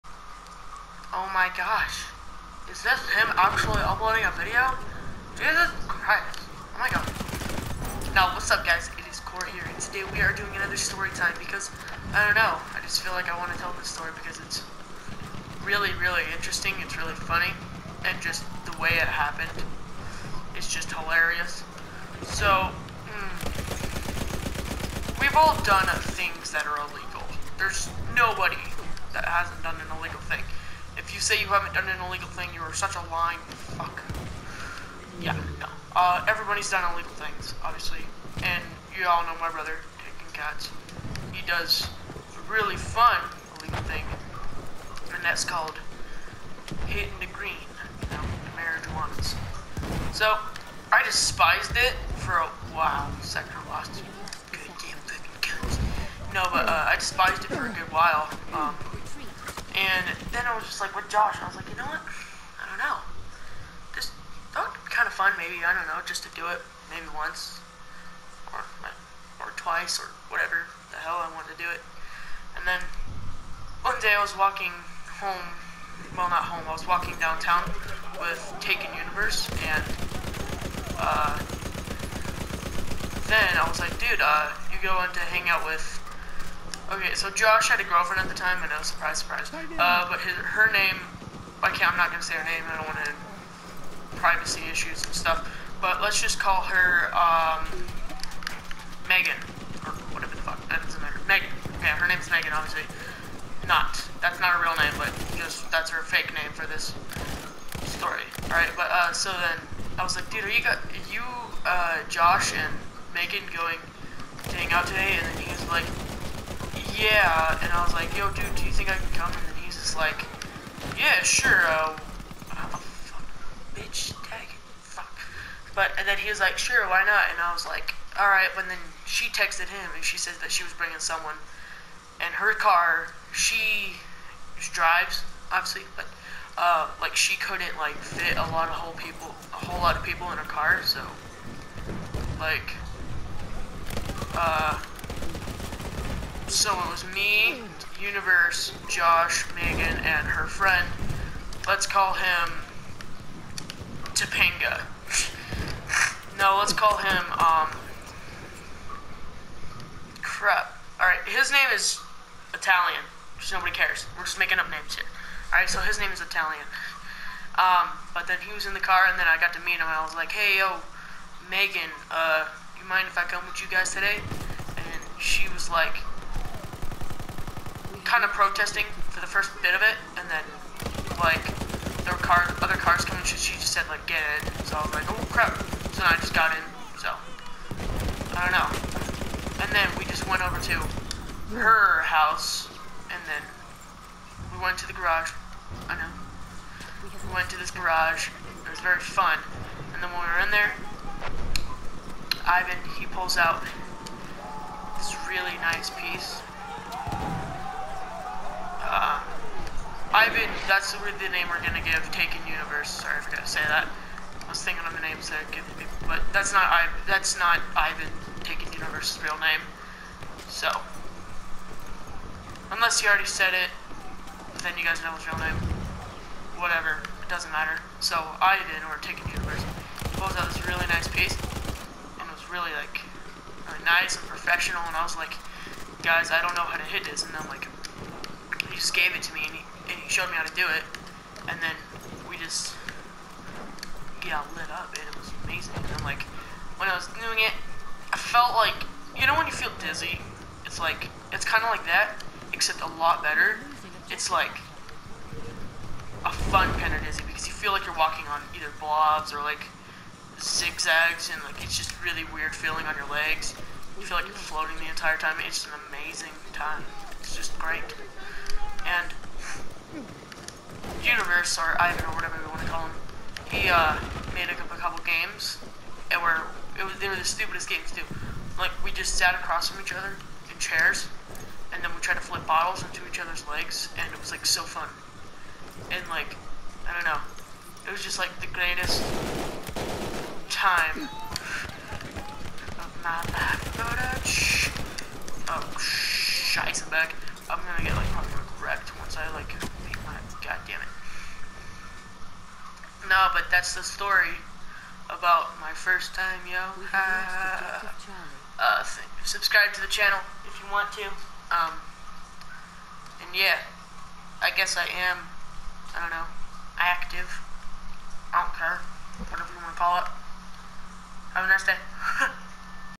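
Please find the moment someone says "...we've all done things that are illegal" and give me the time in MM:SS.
00:25.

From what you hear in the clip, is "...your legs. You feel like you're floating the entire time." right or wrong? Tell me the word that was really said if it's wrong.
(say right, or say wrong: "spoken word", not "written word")
right.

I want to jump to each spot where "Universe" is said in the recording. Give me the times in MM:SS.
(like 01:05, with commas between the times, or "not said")
01:18, 02:28, 03:32, 03:38, 03:49, 04:31.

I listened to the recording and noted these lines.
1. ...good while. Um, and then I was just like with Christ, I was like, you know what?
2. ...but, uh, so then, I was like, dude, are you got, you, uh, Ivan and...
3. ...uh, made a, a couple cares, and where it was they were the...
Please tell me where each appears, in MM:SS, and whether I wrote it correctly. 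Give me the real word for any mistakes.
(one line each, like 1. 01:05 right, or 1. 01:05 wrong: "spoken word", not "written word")
1. 00:57 wrong: "Josh", not "Christ"
2. 01:48 wrong: "Josh", not "Ivan"
3. 04:33 wrong: "games", not "cares".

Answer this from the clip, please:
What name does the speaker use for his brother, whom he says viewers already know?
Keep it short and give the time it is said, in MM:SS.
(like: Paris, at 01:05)
Taking Cats, at 00:40.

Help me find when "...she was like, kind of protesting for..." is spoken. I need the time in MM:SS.
02:55.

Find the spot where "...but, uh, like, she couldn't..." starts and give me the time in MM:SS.
02:15.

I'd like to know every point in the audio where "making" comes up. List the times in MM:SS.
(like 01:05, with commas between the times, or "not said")
02:44.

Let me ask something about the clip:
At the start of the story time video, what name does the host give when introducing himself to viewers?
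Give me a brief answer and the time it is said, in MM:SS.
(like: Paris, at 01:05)
Kore, at 00:09.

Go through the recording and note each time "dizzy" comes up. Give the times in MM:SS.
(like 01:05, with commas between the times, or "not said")
04:09, 04:17.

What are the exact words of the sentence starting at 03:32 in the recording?
Sorry, I forgot to say that.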